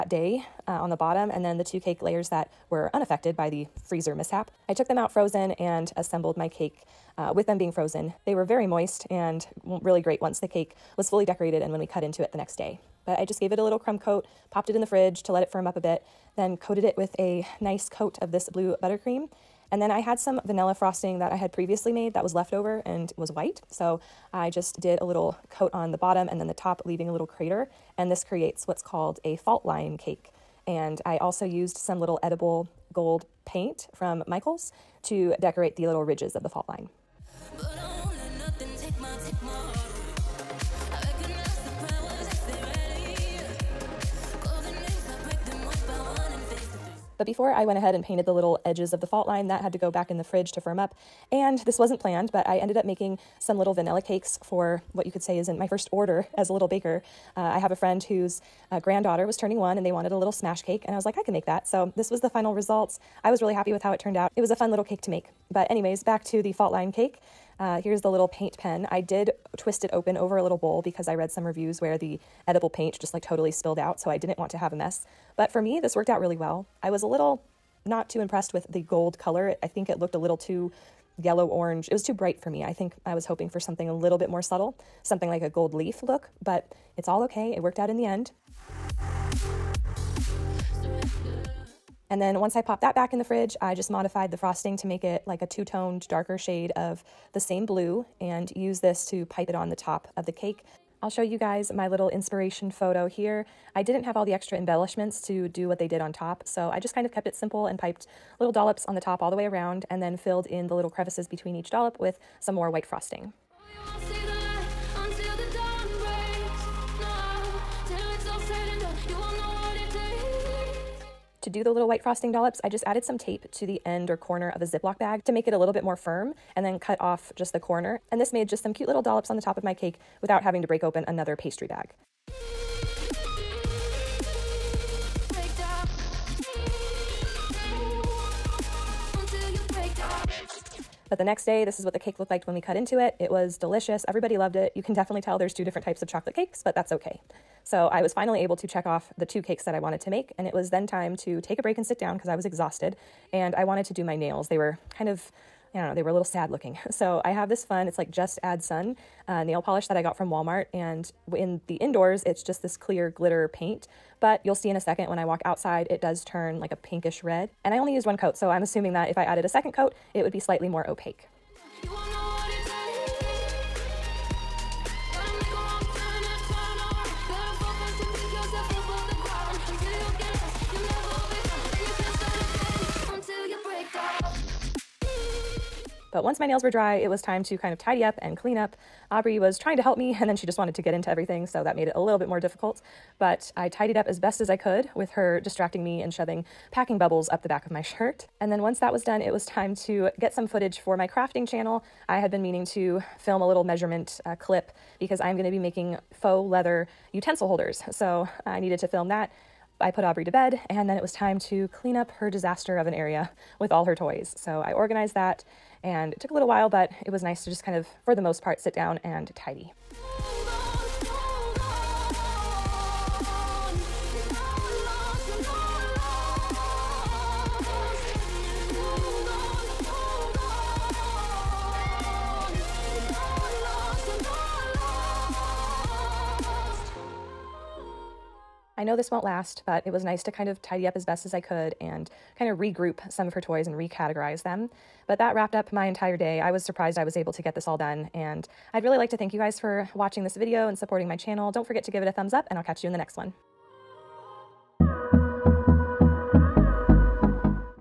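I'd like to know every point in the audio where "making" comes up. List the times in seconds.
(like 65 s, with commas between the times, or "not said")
52 s, 205 s.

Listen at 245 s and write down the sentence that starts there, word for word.
But that wrapped up my entire day.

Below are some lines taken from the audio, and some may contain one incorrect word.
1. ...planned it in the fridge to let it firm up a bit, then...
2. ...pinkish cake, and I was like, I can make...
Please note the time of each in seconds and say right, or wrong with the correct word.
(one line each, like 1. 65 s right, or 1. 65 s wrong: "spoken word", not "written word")
1. 14 s wrong: "popped", not "planned"
2. 60 s wrong: "smash", not "pinkish".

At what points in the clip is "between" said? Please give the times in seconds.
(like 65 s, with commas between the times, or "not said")
111 s.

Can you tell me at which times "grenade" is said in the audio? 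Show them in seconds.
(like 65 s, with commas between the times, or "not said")
not said.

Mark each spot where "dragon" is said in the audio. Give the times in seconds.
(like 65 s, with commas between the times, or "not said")
not said.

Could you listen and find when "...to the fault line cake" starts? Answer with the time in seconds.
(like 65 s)
66 s.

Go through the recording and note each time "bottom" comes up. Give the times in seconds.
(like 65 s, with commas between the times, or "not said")
0 s, 25 s.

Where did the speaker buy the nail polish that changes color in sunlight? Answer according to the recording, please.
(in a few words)
Walmart.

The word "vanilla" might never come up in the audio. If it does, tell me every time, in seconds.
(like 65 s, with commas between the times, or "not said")
20 s, 53 s.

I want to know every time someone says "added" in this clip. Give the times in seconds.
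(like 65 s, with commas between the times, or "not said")
122 s, 169 s.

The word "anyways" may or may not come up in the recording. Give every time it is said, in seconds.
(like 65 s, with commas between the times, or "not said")
65 s.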